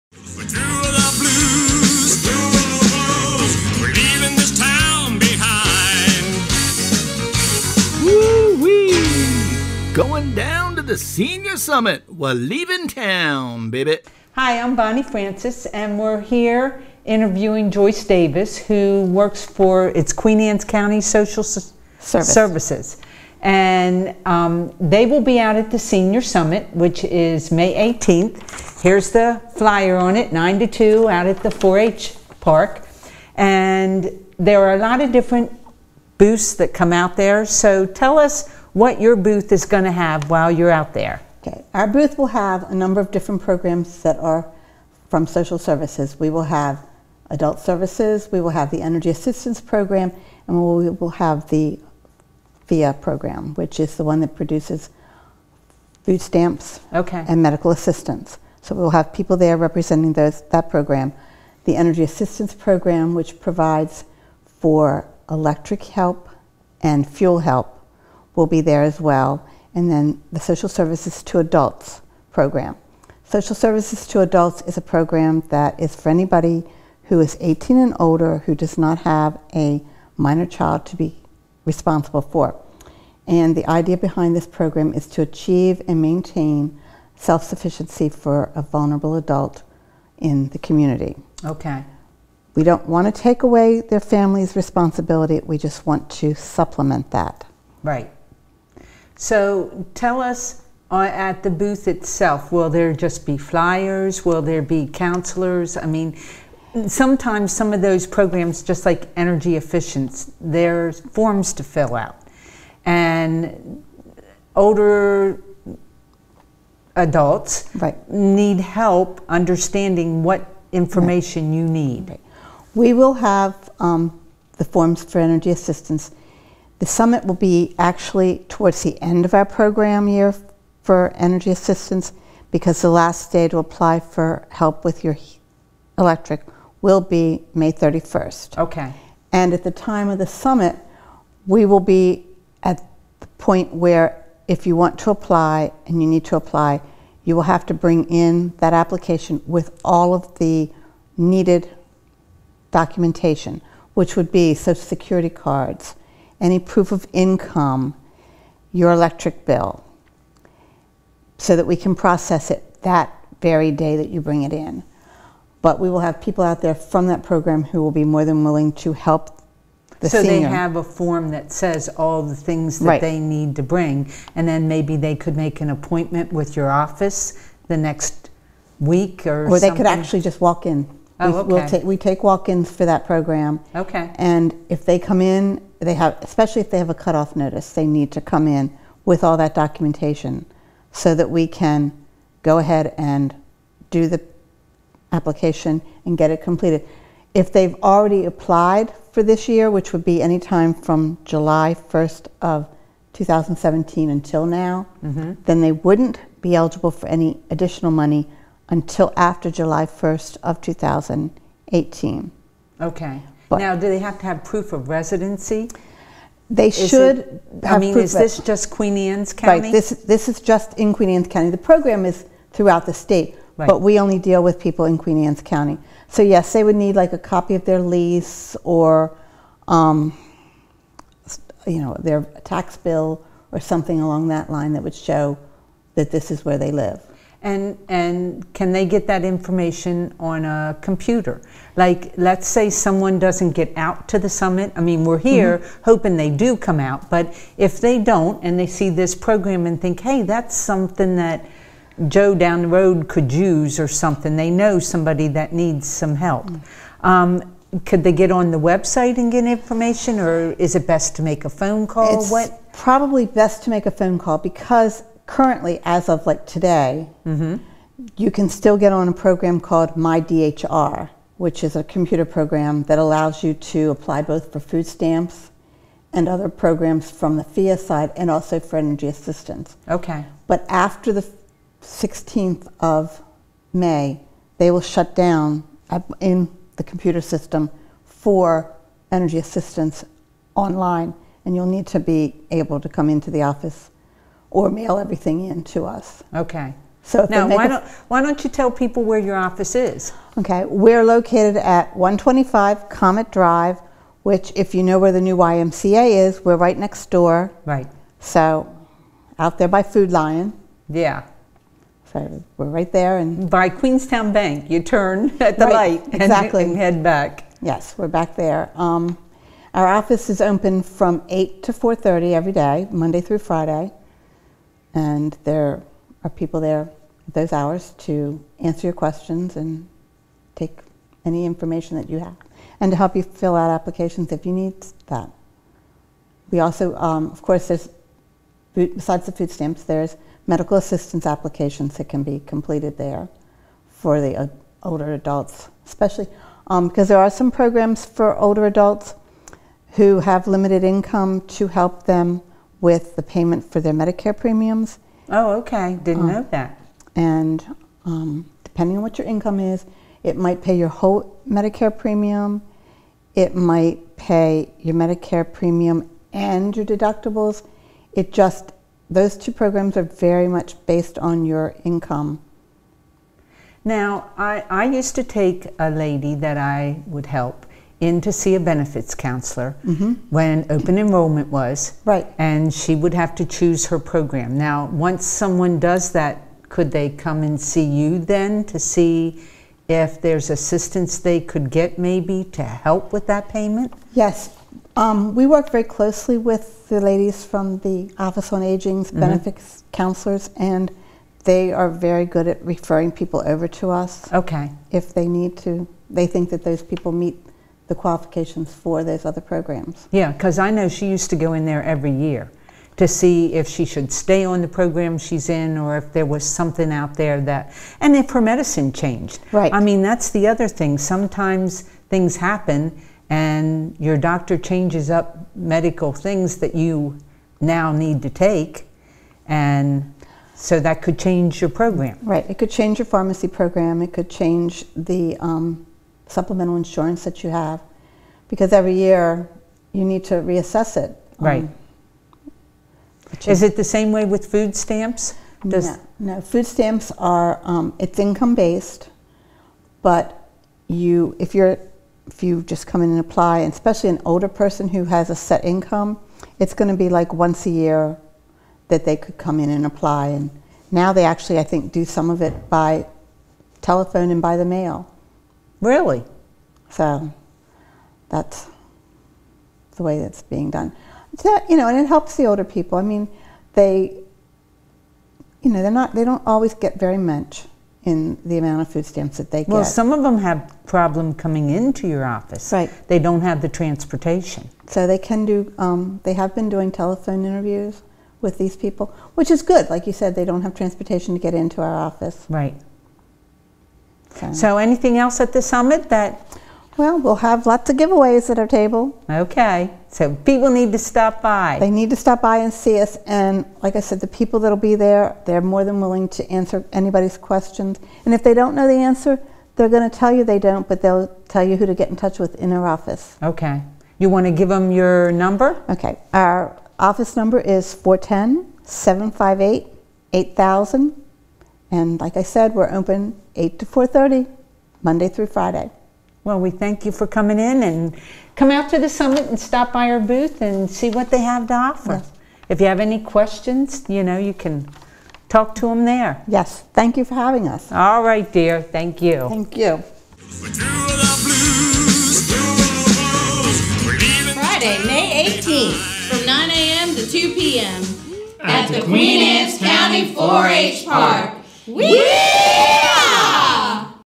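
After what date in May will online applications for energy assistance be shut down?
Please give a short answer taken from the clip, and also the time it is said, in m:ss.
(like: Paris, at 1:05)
16th of May, at 4:41.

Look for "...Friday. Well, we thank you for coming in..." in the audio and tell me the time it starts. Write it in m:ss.
8:45.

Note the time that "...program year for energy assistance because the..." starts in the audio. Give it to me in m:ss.
2:09.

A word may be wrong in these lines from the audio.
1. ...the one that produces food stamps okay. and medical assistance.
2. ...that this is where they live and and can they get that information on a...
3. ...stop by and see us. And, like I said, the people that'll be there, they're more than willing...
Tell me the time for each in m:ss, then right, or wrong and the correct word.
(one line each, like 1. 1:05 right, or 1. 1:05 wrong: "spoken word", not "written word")
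1. 0:53 right
2. 3:55 right
3. 8:22 right.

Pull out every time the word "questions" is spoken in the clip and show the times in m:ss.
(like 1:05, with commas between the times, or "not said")
5:28, 8:27, 8:53.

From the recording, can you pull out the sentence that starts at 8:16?
Well, we'll have lots of giveaways at our table.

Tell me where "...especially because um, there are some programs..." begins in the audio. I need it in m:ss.
5:45.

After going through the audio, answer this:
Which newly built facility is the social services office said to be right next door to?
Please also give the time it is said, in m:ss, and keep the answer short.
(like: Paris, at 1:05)
the new YMCA, at 5:05.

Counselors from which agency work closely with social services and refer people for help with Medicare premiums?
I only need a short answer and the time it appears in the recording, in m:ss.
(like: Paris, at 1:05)
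Office on Aging, at 6:38.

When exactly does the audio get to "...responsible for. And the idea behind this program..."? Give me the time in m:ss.
1:21.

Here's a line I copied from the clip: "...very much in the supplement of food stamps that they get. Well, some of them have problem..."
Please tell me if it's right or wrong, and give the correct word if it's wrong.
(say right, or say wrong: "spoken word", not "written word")
wrong: "amount", not "supplement".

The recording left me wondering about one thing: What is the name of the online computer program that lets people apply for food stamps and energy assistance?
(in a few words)
My DHR.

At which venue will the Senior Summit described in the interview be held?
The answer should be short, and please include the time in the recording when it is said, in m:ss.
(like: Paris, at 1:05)
4-H Park, at 0:31.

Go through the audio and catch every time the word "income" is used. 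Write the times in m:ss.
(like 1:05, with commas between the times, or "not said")
2:37, 5:50, 5:59, 6:11, 7:28, 7:35.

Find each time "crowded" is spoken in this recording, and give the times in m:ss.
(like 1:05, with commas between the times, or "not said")
not said.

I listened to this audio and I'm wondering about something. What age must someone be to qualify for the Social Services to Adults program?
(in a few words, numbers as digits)
18 and older.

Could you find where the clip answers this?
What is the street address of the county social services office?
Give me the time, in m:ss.
5:01.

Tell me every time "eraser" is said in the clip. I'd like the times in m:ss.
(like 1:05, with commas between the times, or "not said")
not said.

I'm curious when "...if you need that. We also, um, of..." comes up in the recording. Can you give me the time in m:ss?
5:34.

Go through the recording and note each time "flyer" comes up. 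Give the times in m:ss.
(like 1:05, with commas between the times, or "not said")
0:29, 1:43.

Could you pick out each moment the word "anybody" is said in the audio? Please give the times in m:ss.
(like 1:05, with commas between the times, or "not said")
1:16, 8:26.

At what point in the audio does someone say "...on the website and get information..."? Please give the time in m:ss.
4:18.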